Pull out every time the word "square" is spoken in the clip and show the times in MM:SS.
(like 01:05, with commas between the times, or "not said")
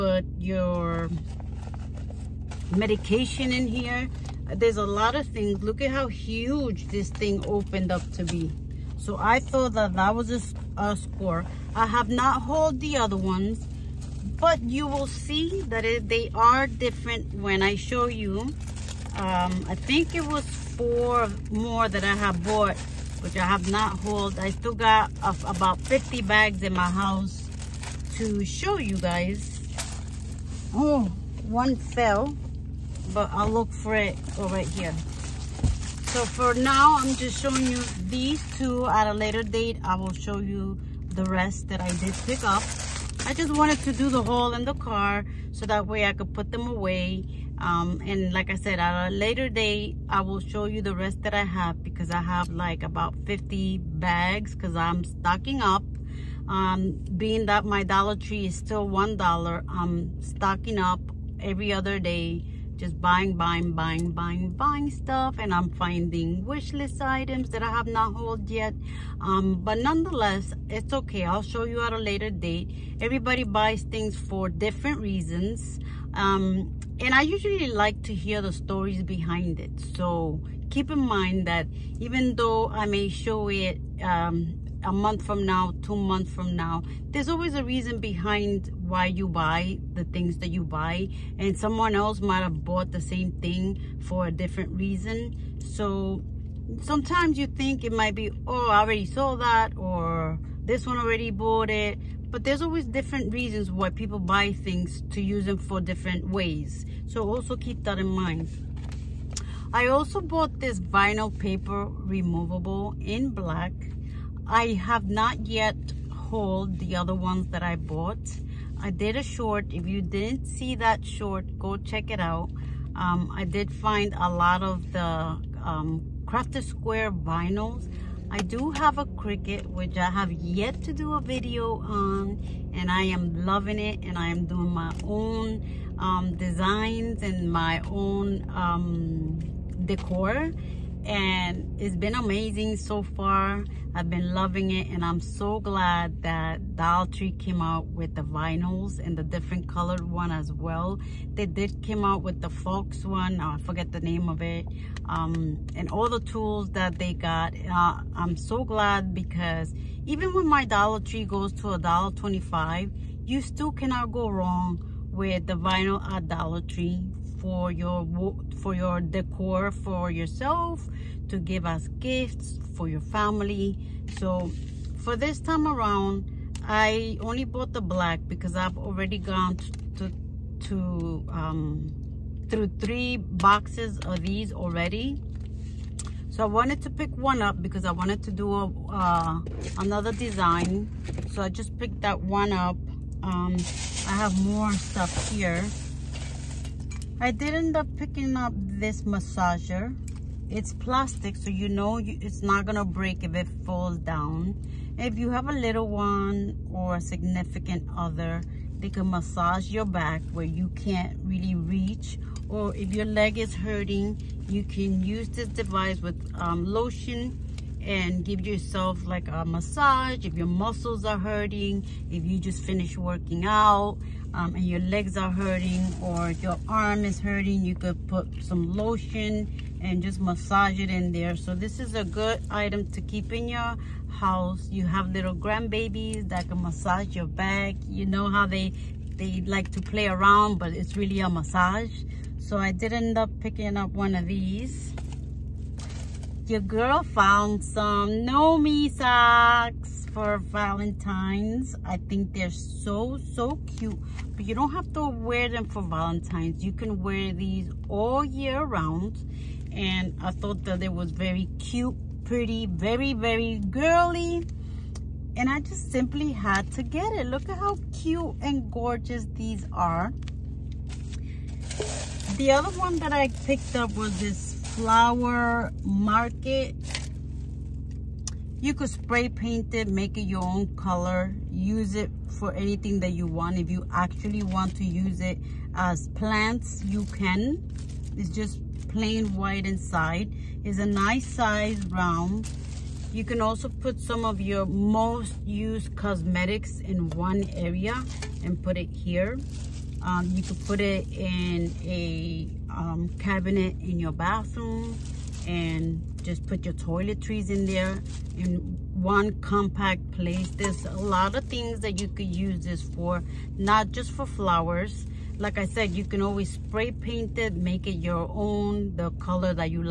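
02:06.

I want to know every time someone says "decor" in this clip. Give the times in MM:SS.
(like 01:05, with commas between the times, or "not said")
02:19, 02:49.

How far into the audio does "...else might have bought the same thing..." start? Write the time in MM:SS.
01:31.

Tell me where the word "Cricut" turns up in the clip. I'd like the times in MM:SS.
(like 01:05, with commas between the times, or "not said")
02:09.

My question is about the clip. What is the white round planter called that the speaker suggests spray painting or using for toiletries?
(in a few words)
Flower market.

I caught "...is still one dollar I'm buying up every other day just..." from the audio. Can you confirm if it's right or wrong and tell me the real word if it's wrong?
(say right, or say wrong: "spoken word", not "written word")
wrong: "stocking", not "buying".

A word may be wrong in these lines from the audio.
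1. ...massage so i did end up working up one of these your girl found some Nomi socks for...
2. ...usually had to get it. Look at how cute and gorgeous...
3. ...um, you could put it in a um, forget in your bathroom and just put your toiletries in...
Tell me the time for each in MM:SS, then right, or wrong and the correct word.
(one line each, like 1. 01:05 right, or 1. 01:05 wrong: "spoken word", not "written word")
1. 04:01 wrong: "picking", not "working"
2. 04:25 wrong: "simply", not "usually"
3. 05:00 wrong: "cabinet", not "forget".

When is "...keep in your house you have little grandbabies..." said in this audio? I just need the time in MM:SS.
03:53.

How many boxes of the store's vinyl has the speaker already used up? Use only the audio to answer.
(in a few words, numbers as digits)
3.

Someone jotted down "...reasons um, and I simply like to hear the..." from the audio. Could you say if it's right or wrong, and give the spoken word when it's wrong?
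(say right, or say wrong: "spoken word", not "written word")
wrong: "usually", not "simply".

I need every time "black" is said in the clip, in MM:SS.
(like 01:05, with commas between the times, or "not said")
01:53, 02:57.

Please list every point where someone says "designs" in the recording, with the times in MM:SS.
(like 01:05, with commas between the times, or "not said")
02:16, 03:10.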